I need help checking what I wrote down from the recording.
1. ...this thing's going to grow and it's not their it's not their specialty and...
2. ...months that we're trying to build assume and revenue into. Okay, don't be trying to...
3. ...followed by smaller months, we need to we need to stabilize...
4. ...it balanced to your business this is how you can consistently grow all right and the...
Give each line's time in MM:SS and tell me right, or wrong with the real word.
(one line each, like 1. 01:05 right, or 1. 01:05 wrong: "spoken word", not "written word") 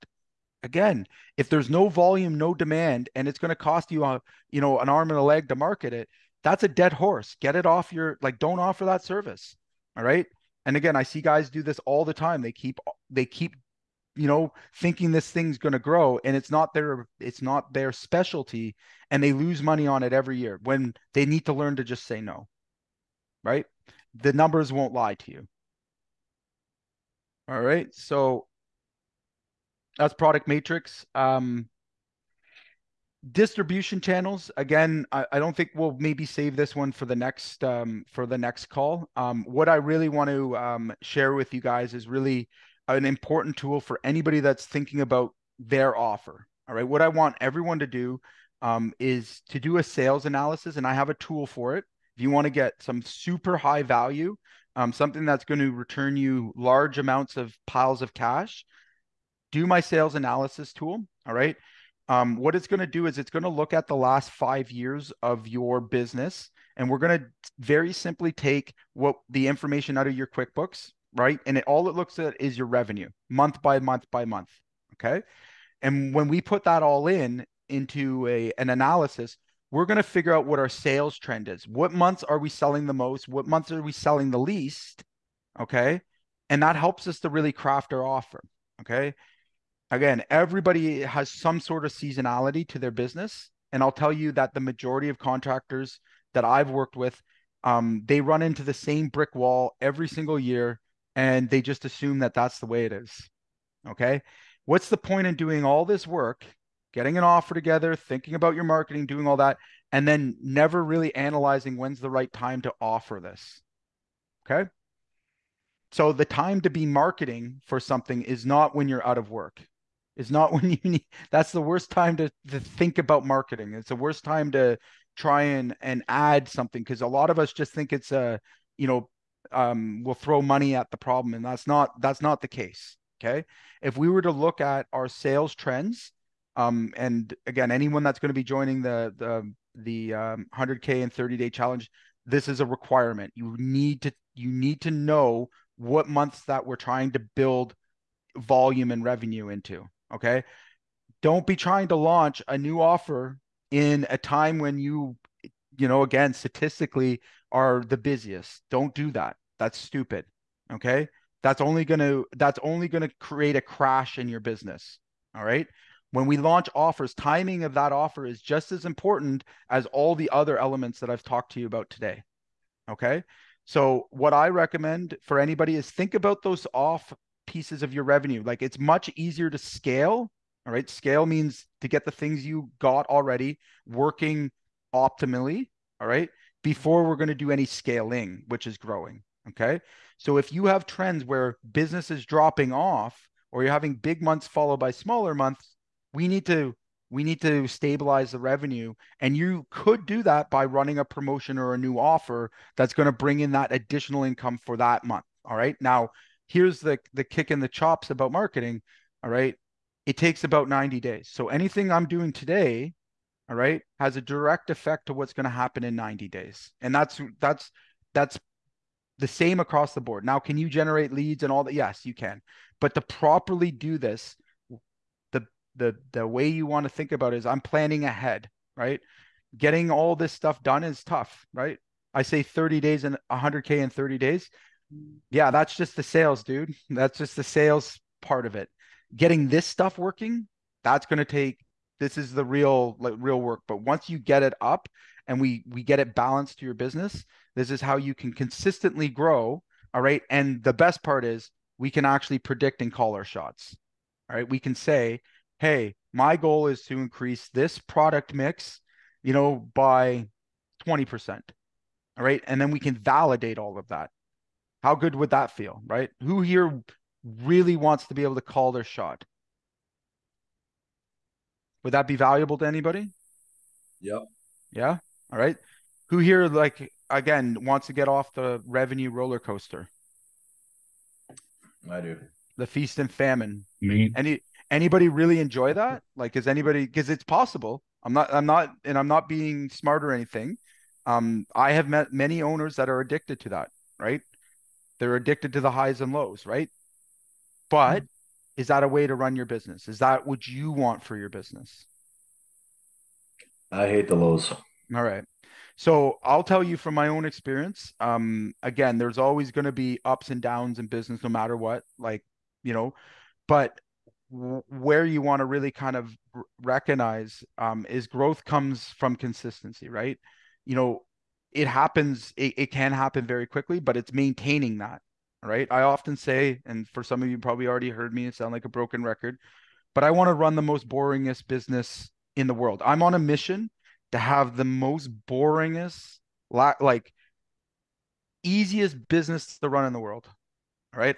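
1. 00:15 right
2. 02:26 wrong: "volume", not "assume"
3. 03:14 right
4. 04:06 right.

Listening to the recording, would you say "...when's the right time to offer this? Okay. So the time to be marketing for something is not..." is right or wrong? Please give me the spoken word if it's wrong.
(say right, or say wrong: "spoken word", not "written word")
right.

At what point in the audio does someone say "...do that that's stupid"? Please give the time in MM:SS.
02:38.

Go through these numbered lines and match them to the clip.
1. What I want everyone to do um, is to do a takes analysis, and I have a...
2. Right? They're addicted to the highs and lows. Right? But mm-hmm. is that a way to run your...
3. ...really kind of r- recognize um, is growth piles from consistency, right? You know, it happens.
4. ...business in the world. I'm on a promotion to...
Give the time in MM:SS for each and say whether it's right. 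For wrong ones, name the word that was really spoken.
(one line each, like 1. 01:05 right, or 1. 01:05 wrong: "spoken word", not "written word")
1. 00:46 wrong: "sales", not "takes"
2. 04:53 right
3. 05:15 wrong: "comes", not "piles"
4. 05:31 wrong: "mission", not "promotion".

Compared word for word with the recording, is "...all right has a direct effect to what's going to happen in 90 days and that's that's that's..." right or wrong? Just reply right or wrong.
right.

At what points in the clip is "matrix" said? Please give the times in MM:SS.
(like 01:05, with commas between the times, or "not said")
00:30.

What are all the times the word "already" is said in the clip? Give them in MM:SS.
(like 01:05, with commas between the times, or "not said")
03:03, 05:27.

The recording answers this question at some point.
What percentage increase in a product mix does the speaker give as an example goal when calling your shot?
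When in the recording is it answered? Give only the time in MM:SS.
04:20.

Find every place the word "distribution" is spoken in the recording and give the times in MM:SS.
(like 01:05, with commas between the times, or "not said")
00:33.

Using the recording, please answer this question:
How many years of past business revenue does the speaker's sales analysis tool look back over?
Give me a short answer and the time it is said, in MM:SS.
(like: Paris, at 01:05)
5, at 01:04.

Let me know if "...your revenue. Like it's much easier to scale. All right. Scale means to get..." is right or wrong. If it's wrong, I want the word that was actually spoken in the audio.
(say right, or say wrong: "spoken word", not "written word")
right.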